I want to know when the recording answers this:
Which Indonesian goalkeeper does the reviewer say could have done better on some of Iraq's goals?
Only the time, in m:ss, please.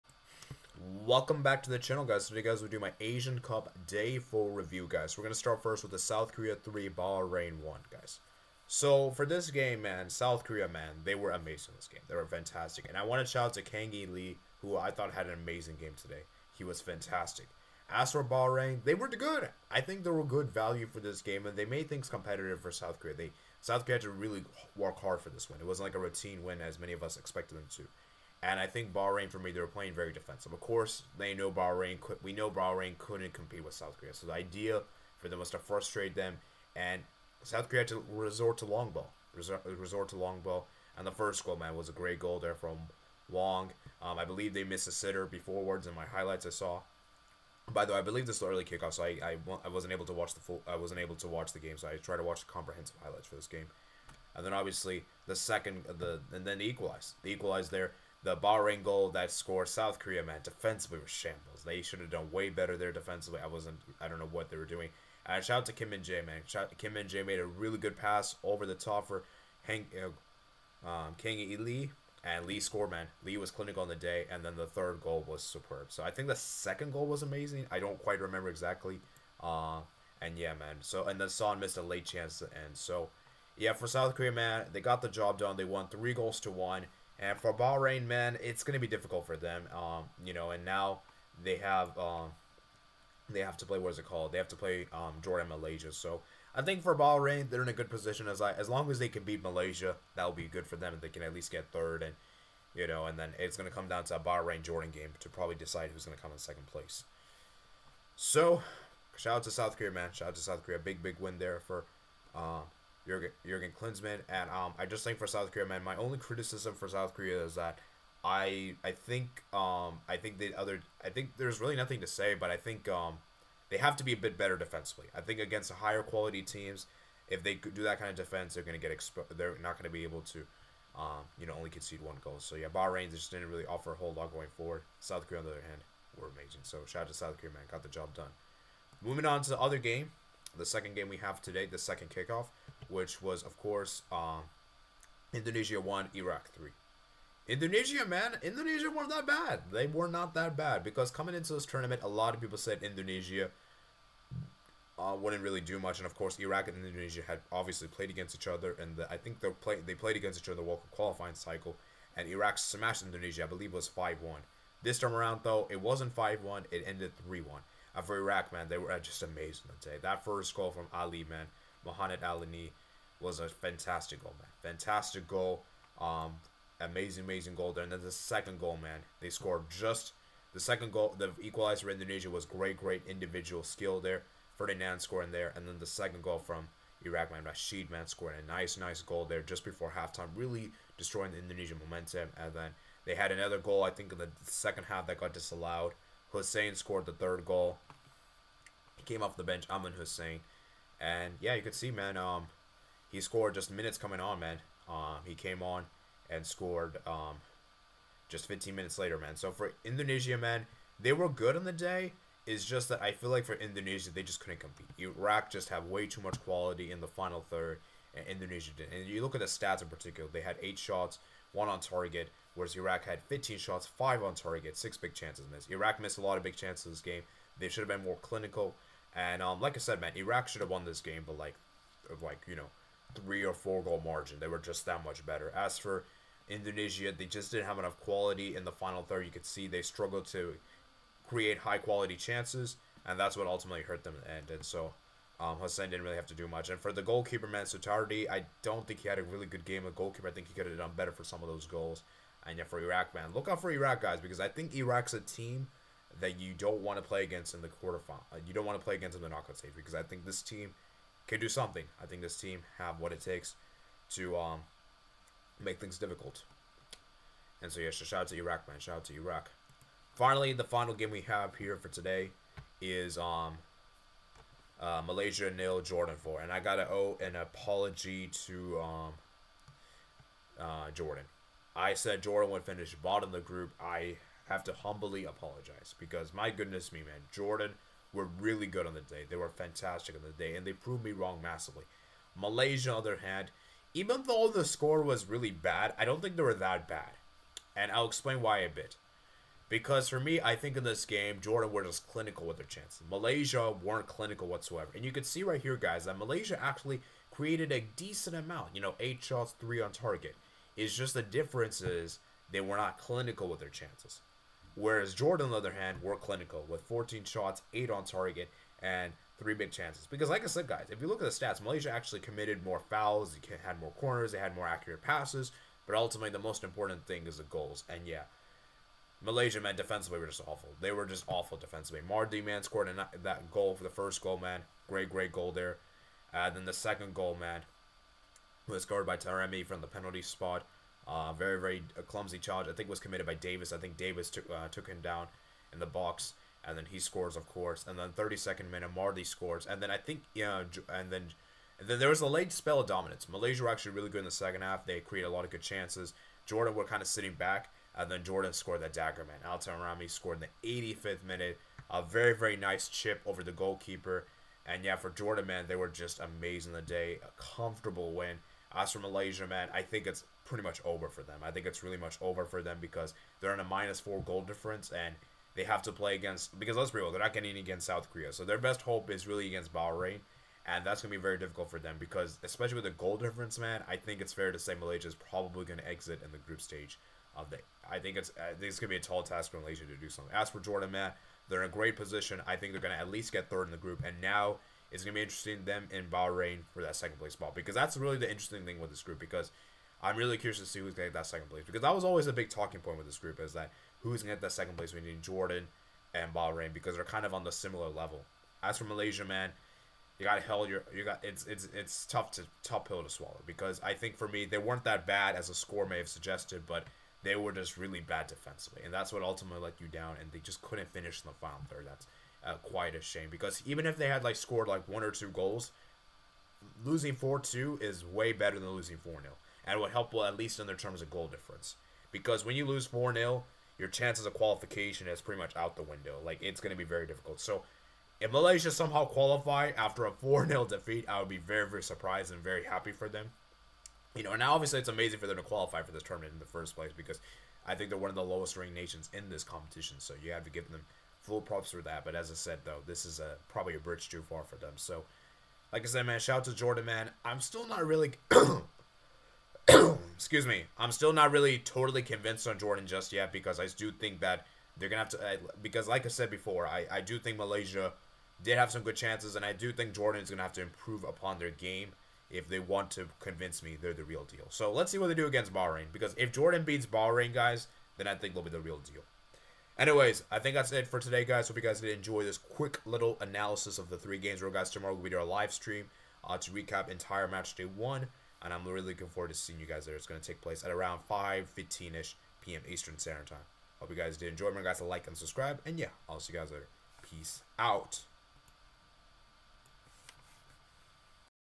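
4:07.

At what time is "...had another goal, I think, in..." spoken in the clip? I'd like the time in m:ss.
3:13.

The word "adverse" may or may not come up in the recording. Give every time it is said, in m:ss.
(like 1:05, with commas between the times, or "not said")
not said.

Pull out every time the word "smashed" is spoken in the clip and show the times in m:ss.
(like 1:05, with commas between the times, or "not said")
2:42.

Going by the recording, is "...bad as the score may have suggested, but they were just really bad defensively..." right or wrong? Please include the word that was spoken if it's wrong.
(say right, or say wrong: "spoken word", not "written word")
right.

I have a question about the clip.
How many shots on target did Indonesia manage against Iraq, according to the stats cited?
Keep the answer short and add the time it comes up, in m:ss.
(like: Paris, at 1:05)
1, at 3:41.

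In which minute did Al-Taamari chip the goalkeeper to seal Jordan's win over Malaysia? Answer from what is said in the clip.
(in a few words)
85th.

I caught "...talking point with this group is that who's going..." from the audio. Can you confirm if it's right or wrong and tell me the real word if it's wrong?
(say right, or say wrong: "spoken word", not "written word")
right.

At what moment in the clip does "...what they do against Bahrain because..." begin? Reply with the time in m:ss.
7:54.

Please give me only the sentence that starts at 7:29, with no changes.
So, you have to give them full props for that.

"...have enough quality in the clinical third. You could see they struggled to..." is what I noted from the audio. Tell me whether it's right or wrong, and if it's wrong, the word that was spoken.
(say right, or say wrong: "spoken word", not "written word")
wrong: "final", not "clinical".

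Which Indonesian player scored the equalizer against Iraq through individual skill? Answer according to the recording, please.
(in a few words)
Ferdinand.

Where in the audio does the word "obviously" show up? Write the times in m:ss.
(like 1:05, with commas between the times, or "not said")
0:54, 2:37, 7:24.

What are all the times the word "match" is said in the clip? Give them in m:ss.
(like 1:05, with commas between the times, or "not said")
8:07.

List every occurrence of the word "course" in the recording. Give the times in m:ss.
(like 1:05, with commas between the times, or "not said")
0:30, 2:23, 2:36, 5:47.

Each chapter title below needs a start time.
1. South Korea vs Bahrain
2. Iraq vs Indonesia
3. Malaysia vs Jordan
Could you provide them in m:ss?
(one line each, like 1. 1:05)
1. 0:20
2. 2:40
3. 5:00.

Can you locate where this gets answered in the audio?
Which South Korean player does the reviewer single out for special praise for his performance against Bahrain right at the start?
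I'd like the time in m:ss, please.
0:13.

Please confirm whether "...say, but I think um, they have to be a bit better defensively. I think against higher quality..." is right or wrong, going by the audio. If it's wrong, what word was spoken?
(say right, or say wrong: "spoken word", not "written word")
right.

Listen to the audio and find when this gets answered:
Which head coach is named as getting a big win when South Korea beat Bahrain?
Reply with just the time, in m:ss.
1:53.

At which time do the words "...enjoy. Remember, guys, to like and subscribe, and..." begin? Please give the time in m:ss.
8:14.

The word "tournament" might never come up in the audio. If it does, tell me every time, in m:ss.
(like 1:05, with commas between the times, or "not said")
2:31, 7:26.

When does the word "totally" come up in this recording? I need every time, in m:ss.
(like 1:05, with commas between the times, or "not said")
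7:41.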